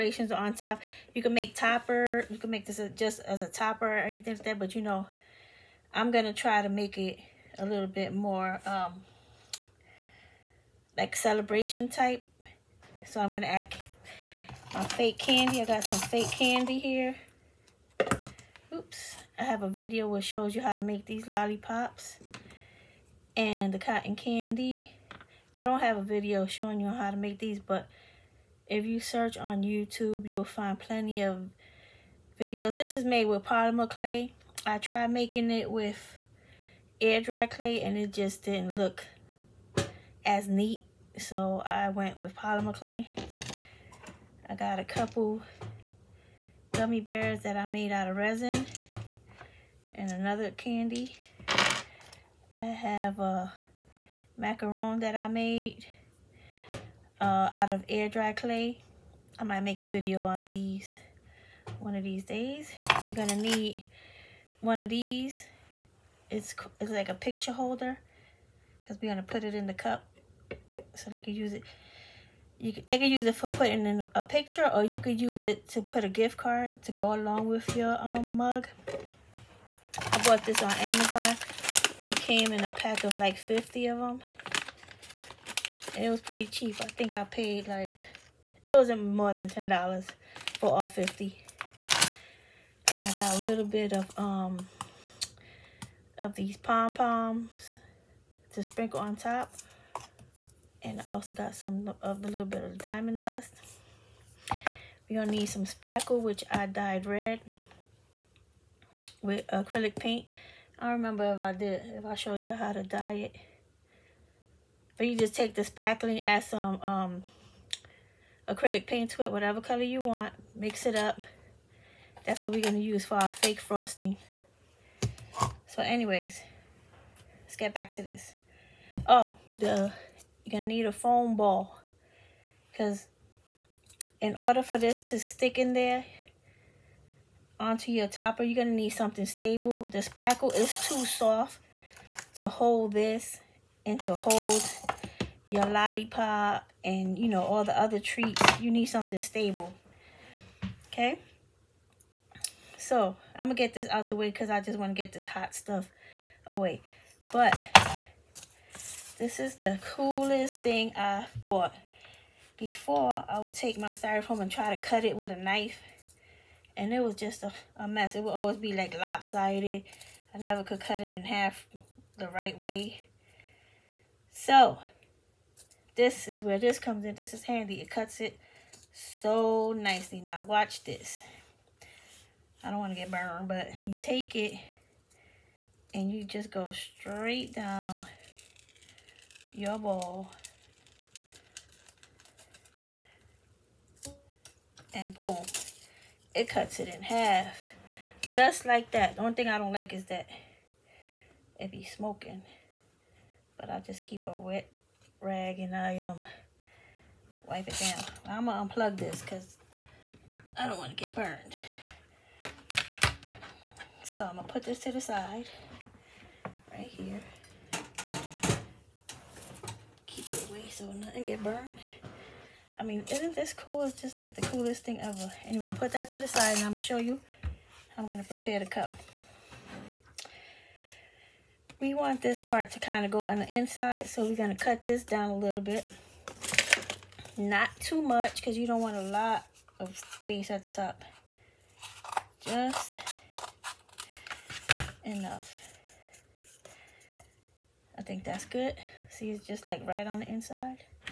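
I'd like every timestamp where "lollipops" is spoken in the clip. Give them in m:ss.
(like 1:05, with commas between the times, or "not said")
0:21, 2:25.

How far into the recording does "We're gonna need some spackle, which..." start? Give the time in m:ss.
1:45.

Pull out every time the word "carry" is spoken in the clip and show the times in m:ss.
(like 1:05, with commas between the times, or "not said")
not said.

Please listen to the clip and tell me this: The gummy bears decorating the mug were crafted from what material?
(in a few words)
resin.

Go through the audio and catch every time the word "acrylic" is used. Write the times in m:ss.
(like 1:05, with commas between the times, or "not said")
1:49, 1:58.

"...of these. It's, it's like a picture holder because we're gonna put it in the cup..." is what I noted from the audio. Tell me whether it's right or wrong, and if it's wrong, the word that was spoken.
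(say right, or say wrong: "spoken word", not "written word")
right.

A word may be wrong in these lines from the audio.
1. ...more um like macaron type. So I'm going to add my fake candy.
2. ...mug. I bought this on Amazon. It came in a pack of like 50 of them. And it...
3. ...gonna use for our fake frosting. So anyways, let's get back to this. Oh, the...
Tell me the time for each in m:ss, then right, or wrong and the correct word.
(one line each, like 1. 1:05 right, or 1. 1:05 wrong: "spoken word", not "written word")
1. 0:08 wrong: "celebration", not "macaron"
2. 1:18 right
3. 2:02 right.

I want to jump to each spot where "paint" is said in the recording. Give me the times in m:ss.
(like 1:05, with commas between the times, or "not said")
1:49, 1:58.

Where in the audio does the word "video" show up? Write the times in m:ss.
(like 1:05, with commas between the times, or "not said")
0:19, 0:26, 0:32, 0:59.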